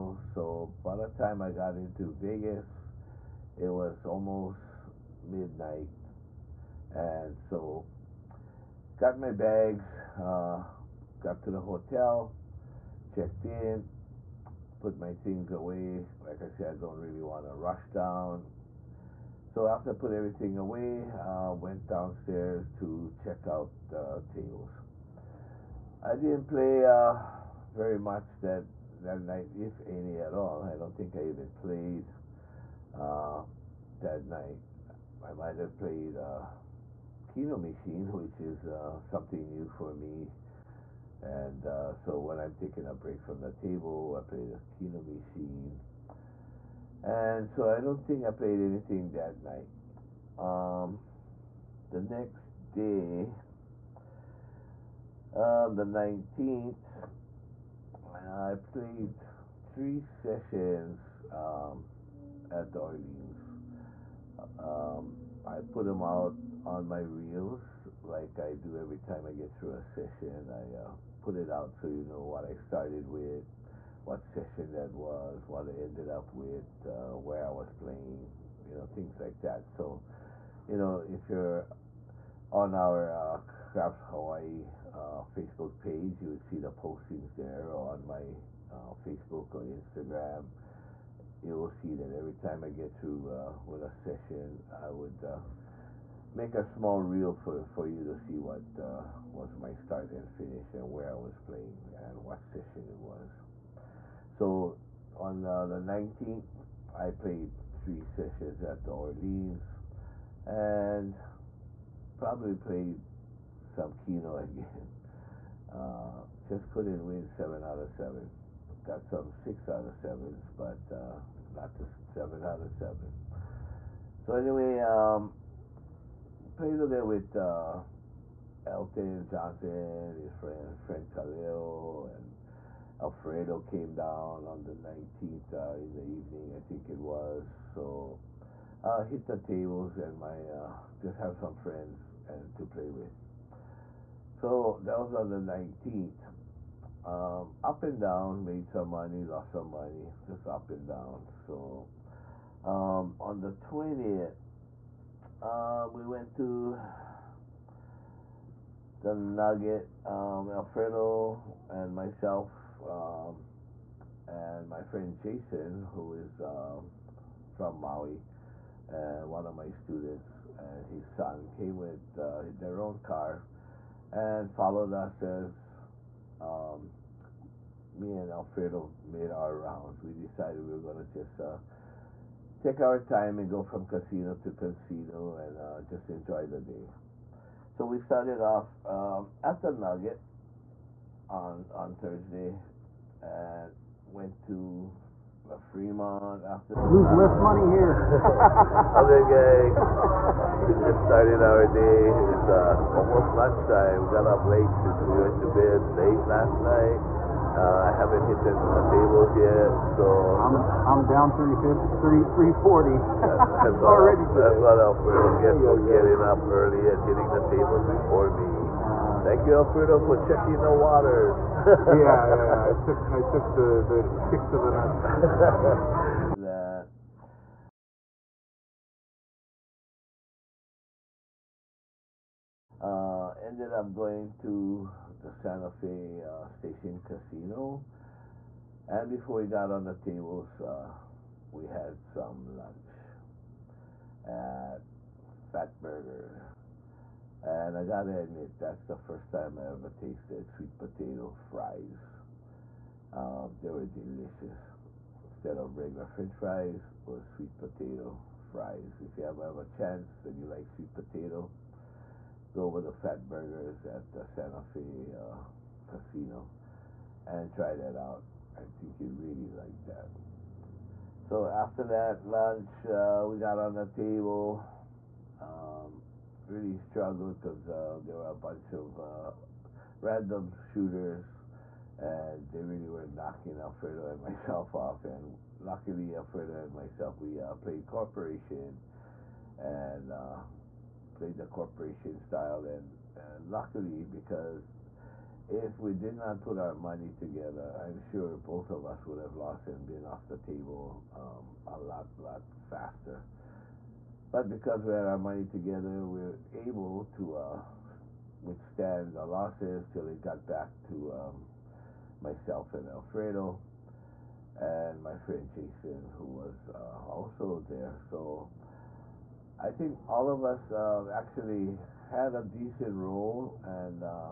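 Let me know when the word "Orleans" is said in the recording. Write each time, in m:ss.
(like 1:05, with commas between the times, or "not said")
1:02, 1:48.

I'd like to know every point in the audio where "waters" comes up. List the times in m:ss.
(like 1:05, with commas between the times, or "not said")
3:40.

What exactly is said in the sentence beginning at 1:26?
You would see the postings there on my uh, Facebook or Instagram.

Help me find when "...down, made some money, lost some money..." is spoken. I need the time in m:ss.
2:27.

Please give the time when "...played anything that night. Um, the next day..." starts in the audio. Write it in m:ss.
0:48.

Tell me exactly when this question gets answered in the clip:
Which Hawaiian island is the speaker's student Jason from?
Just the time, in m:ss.
2:47.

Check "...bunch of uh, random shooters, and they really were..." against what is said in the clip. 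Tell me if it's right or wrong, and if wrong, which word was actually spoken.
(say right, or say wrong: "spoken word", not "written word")
right.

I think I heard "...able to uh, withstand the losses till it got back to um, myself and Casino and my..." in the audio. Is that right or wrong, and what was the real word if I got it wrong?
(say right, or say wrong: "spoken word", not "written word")
wrong: "Alfredo", not "Casino".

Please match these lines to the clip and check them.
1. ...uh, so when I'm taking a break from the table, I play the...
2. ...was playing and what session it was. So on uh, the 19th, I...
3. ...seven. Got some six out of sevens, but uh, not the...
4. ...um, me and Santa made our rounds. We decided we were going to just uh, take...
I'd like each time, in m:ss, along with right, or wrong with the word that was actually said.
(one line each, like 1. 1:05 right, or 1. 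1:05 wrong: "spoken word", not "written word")
1. 0:41 right
2. 1:41 right
3. 1:57 right
4. 2:56 wrong: "Alfredo", not "Santa".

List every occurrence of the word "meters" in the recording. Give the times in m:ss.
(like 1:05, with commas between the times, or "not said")
not said.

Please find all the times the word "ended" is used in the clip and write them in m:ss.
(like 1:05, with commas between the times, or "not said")
1:15, 3:53.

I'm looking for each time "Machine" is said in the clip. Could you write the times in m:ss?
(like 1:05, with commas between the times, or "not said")
0:37, 0:45.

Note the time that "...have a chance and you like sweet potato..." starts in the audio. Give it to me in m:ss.
4:19.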